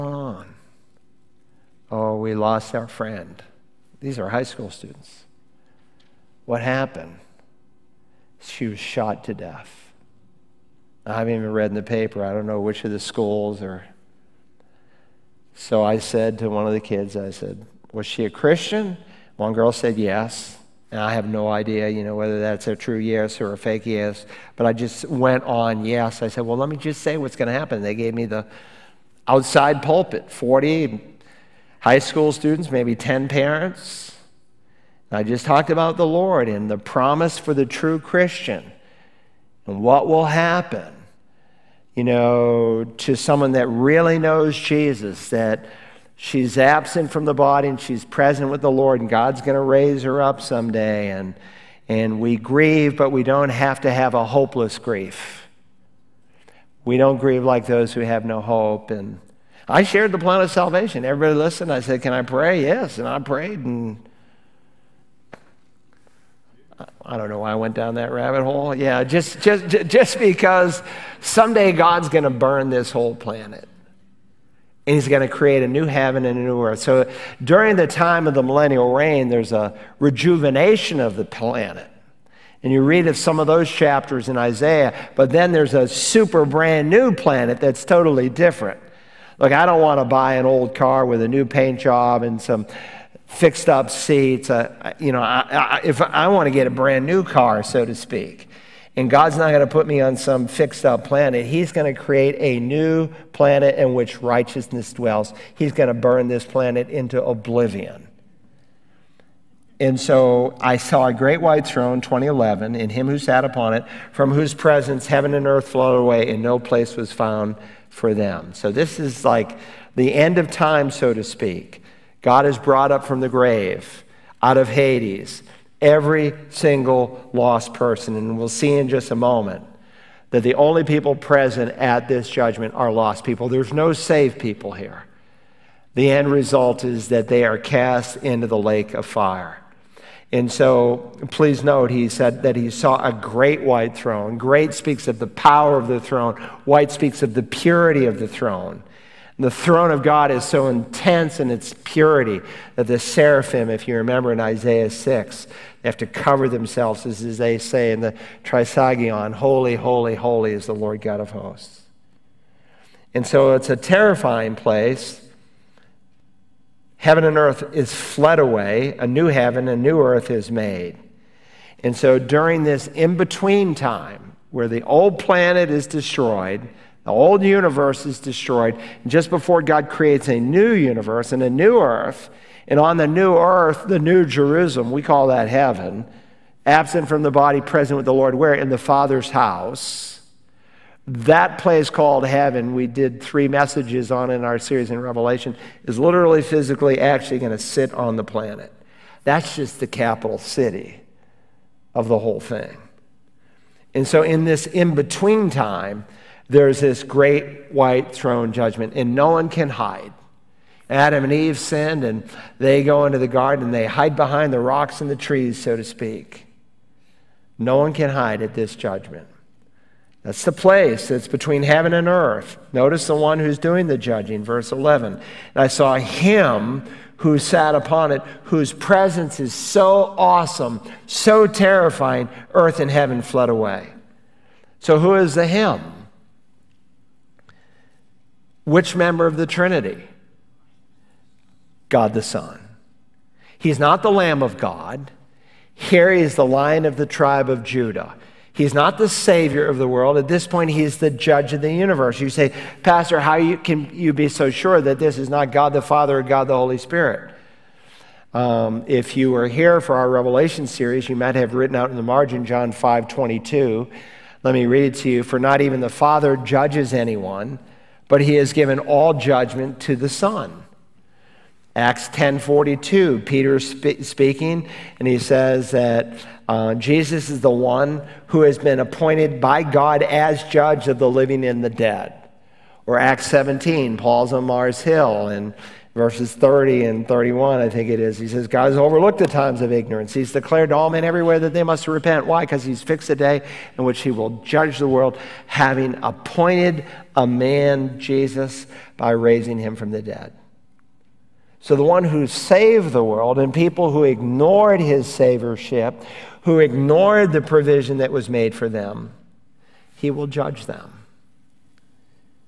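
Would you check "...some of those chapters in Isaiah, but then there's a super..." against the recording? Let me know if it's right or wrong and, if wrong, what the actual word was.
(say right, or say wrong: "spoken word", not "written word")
right.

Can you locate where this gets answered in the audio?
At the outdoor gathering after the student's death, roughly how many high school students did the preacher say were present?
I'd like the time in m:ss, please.
0:30.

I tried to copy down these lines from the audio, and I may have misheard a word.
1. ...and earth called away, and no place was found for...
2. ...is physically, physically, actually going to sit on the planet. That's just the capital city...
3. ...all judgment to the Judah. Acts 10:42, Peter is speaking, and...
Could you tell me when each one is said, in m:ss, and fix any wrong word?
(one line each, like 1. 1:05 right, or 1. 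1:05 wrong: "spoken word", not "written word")
1. 1:55 wrong: "flowed", not "called"
2. 3:15 wrong: "literally", not "physically"
3. 4:28 wrong: "Son", not "Judah".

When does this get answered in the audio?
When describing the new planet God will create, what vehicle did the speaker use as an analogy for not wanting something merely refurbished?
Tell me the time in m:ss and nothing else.
1:30.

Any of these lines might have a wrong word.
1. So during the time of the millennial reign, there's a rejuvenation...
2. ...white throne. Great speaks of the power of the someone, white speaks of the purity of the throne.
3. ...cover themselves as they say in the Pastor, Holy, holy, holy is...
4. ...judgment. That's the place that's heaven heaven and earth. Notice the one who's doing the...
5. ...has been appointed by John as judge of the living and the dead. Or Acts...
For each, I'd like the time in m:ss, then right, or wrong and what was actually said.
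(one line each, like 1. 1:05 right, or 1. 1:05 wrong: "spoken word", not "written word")
1. 1:16 right
2. 2:23 wrong: "throne", not "someone"
3. 2:36 wrong: "Trisagion", not "Pastor"
4. 3:38 wrong: "between", not "heaven"
5. 4:38 wrong: "God", not "John".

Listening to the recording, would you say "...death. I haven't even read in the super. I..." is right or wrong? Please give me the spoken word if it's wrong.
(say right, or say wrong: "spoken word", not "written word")
wrong: "paper", not "super".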